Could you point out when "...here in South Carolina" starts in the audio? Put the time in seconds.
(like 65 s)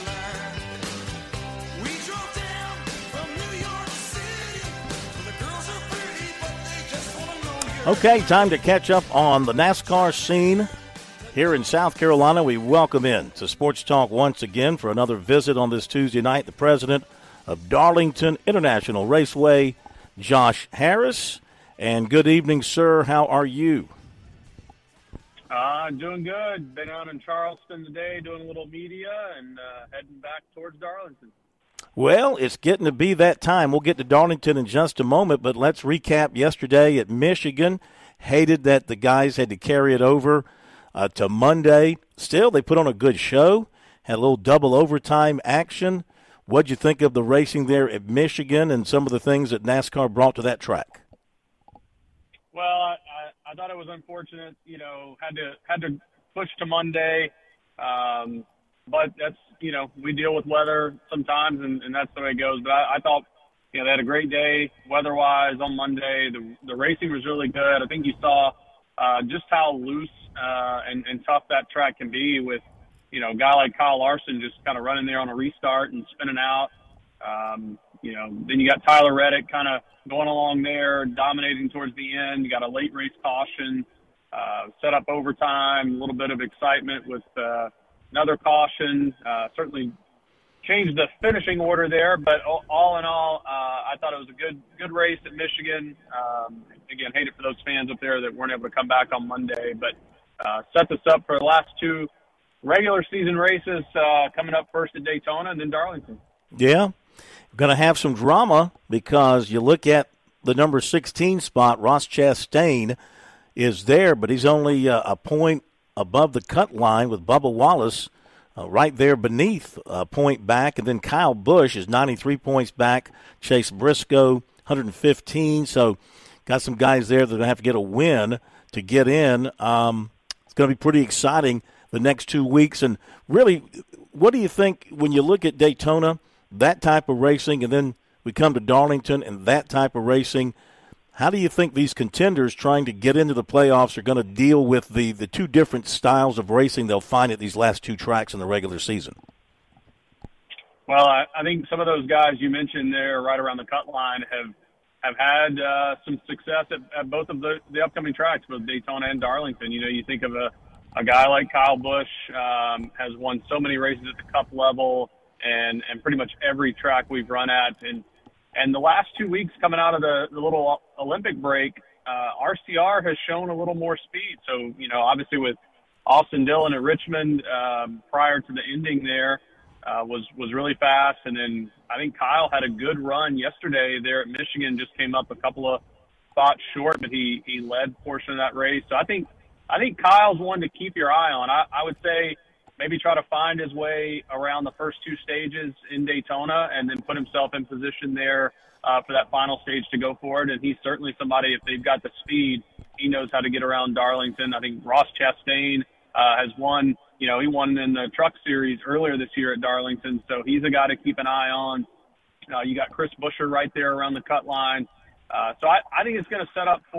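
11 s.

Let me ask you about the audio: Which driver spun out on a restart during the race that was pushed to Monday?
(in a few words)
Kyle Larson.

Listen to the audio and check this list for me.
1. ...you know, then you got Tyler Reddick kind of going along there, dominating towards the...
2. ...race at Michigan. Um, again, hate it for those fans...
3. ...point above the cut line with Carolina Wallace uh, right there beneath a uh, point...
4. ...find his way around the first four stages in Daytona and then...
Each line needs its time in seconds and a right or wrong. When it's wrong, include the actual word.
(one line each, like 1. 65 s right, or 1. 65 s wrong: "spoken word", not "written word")
1. 78 s right
2. 94 s right
3. 115 s wrong: "Bubba", not "Carolina"
4. 193 s wrong: "two", not "four".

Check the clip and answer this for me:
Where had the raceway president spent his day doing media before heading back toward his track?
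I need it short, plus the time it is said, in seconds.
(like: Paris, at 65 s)
Charleston, at 27 s.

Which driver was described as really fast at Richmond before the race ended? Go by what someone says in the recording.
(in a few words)
Austin Dillon.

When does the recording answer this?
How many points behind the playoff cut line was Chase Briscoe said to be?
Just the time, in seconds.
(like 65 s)
124 s.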